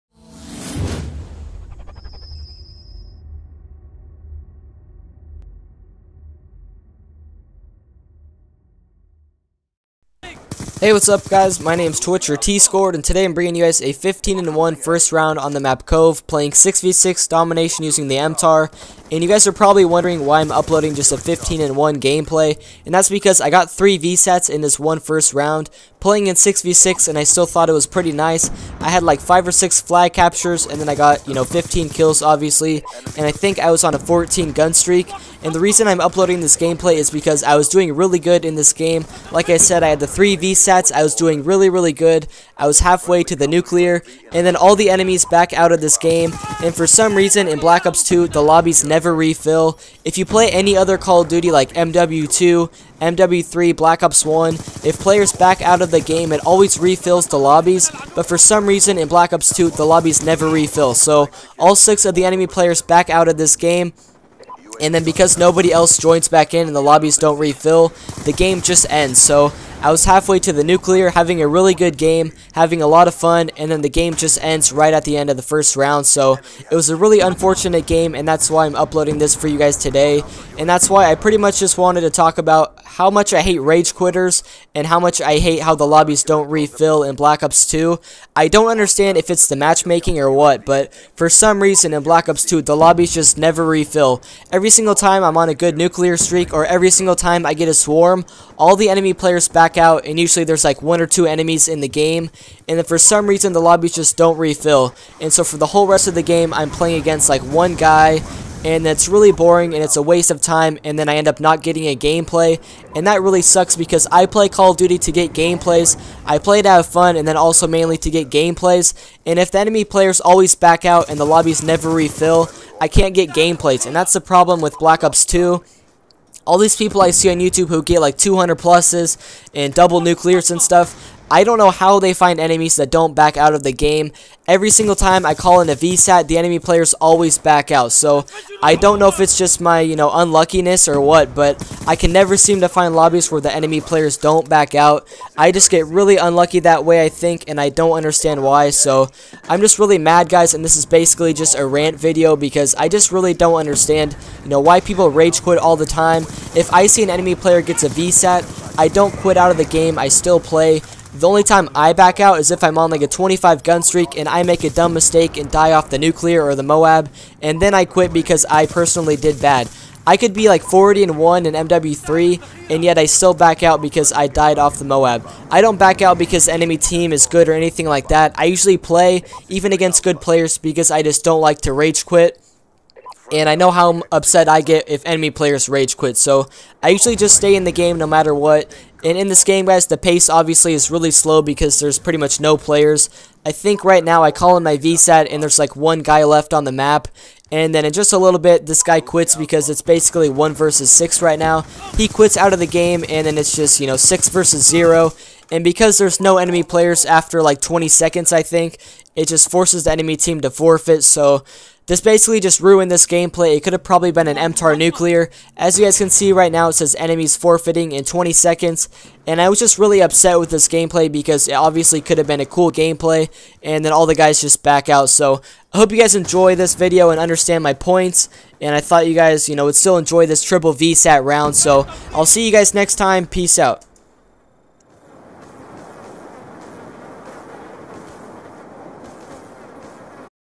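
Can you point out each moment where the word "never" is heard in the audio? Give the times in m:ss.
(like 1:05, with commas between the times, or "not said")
0:48, 1:00, 1:33, 2:01, 2:22.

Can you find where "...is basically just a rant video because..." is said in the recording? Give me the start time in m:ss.
2:30.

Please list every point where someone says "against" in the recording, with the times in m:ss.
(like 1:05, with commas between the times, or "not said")
1:47, 2:59.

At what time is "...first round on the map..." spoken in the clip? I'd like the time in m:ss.
0:14.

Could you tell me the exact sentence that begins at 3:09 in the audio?
And in this game, guys, the pace obviously is really slow because there's pretty much no players.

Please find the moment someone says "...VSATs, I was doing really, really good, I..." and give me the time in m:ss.
0:40.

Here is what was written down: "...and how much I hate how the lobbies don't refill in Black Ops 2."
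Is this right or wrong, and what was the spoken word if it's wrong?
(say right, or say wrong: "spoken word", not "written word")
right.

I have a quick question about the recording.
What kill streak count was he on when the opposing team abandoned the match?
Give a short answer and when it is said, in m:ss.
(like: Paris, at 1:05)
14, at 0:33.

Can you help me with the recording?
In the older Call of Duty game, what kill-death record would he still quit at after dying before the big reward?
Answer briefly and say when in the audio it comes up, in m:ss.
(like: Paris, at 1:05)
40 and 1, at 2:50.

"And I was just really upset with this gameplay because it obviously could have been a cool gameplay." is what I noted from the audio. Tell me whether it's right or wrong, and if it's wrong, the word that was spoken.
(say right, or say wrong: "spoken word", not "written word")
right.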